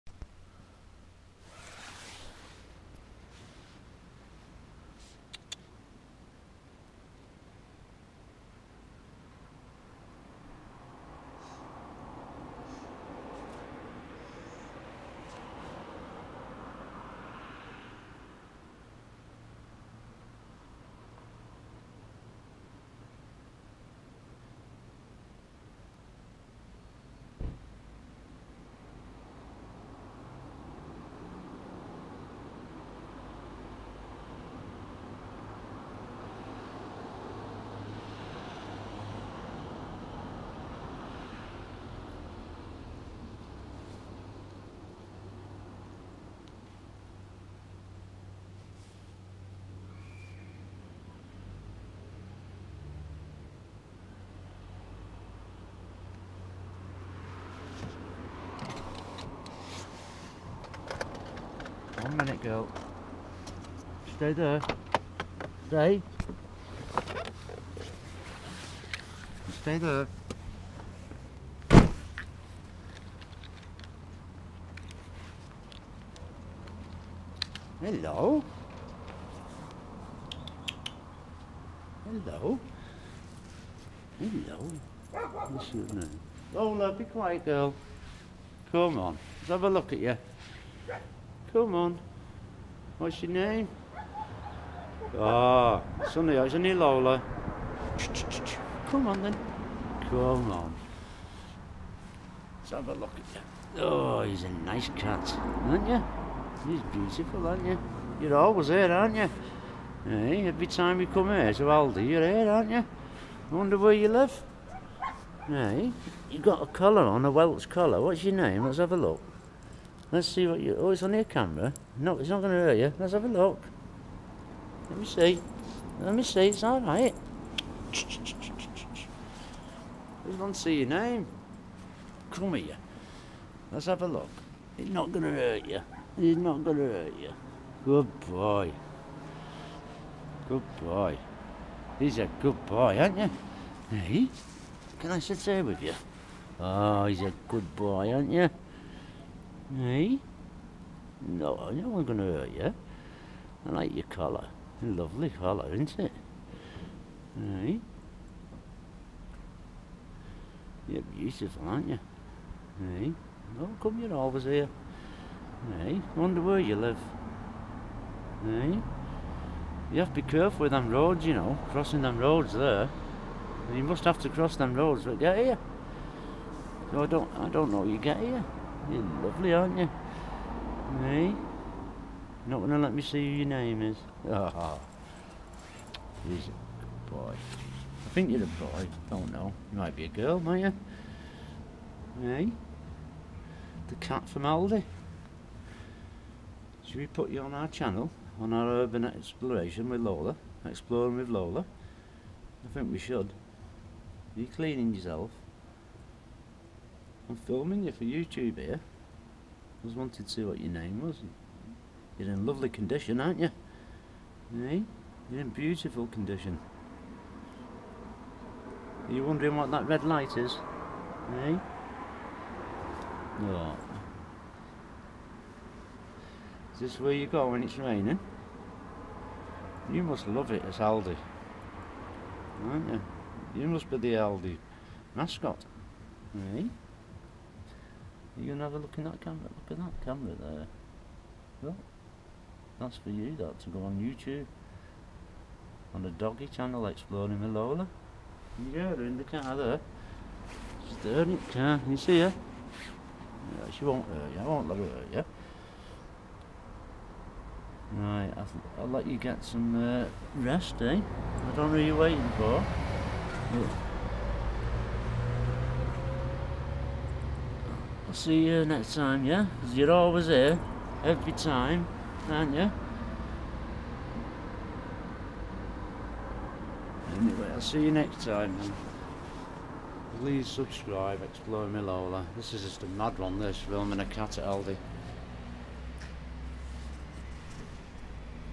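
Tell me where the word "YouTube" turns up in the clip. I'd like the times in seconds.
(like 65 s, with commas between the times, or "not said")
208 s, 243 s.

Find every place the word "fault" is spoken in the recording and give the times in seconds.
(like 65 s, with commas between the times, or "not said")
not said.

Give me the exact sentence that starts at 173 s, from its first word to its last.
You must have to cross them roads, but get here.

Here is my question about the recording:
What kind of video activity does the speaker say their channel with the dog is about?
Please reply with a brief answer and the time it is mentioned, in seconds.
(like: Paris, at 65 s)
urban exploration, at 198 s.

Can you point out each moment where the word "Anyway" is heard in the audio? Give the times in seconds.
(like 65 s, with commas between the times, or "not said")
277 s.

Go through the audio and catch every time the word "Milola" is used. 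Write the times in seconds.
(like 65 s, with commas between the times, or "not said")
281 s.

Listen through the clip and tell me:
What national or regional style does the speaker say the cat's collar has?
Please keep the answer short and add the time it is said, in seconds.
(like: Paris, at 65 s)
Welsh, at 117 s.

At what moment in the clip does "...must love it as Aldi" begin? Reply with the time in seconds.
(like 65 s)
230 s.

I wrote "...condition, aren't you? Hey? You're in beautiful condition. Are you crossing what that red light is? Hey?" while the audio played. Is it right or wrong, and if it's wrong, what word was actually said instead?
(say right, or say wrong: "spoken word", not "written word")
wrong: "wondering", not "crossing".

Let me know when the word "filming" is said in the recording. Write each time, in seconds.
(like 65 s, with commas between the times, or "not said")
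207 s, 283 s.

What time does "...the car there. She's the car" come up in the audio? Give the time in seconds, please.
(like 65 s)
249 s.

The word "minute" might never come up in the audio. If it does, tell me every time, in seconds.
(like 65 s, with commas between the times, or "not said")
62 s.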